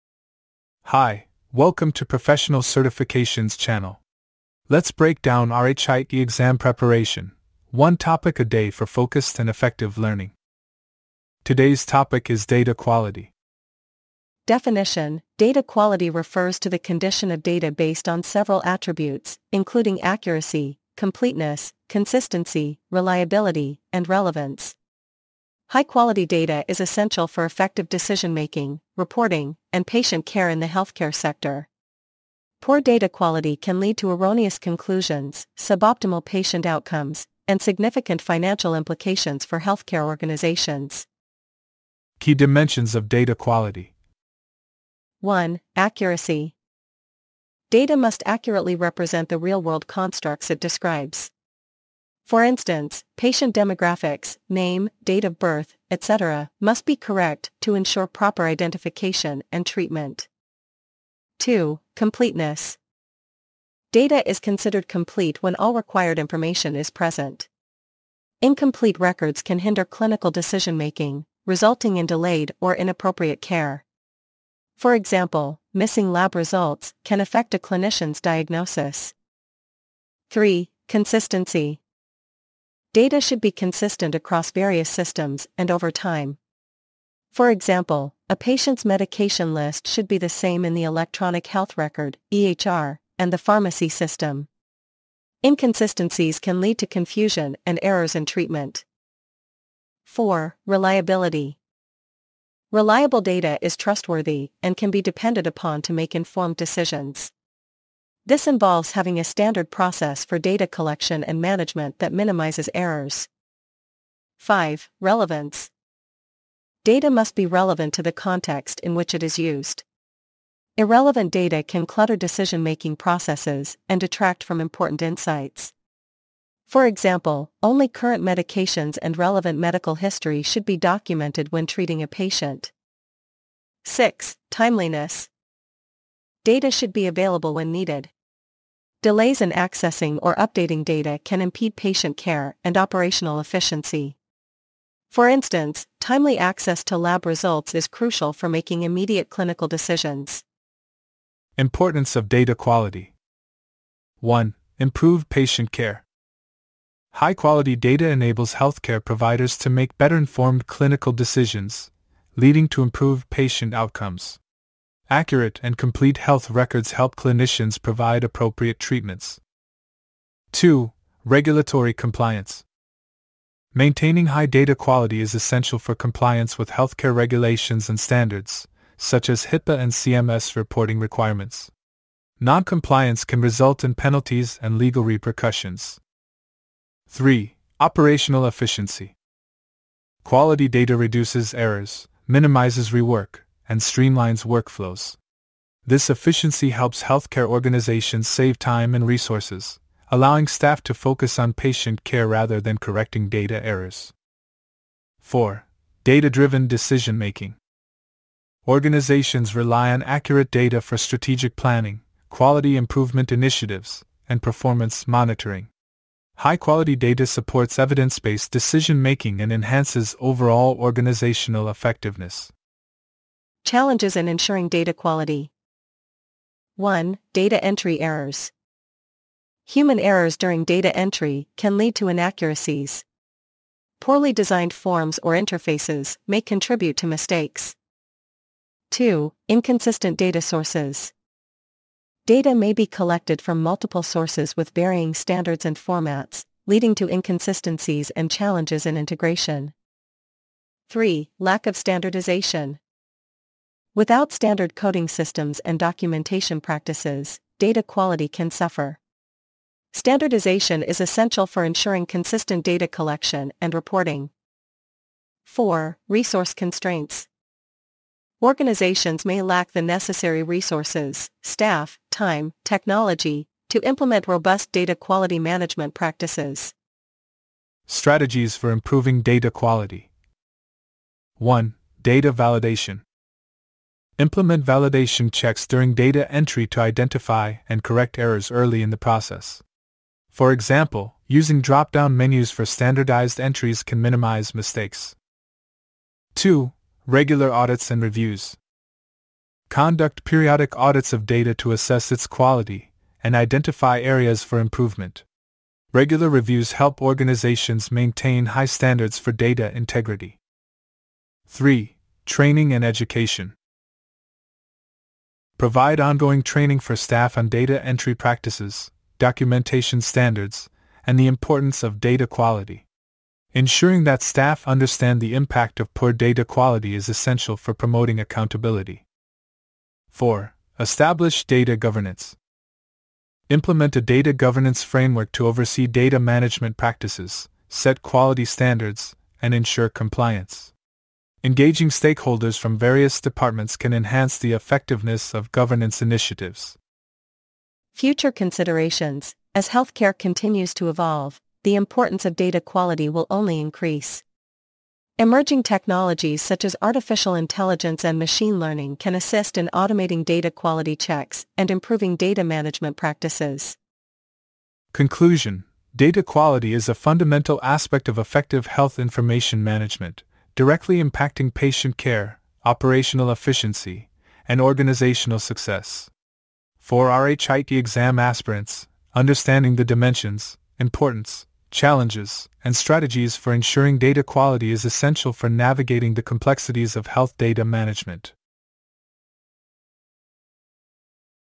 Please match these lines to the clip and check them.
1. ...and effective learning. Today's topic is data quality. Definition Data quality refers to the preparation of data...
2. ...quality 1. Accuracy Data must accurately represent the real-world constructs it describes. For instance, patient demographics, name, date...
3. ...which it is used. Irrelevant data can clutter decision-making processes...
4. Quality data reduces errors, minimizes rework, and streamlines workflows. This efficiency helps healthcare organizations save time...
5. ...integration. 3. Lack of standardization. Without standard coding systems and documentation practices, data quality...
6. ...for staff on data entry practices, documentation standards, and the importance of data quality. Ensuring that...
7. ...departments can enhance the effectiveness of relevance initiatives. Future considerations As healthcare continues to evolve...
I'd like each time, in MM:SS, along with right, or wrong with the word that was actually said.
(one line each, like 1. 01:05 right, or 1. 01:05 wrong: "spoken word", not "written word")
1. 00:09 wrong: "condition", not "preparation"
2. 00:43 right
3. 01:58 right
4. 03:10 right
5. 04:08 right
6. 05:16 right
7. 05:43 wrong: "governance", not "relevance".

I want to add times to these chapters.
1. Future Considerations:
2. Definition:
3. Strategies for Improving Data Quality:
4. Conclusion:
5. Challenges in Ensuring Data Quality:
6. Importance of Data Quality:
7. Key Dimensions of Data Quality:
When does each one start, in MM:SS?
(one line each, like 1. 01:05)
1. 05:47
2. 00:14
3. 04:37
4. 06:04
5. 03:43
6. 02:31
7. 00:41.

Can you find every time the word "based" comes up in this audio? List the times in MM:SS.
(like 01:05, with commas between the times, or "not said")
00:17, 03:37.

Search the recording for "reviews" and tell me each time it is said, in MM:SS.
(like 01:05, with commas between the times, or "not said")
04:58, 05:06.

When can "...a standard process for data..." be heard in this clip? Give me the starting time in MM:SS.
01:49.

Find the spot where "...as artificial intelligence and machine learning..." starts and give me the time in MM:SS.
05:56.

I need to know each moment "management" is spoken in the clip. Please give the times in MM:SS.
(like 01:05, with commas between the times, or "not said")
01:51, 04:35, 05:36, 06:02, 06:09, 06:27.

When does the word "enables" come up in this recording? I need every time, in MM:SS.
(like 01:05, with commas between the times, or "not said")
02:38.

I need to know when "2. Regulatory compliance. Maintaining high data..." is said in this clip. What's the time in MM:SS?
02:50.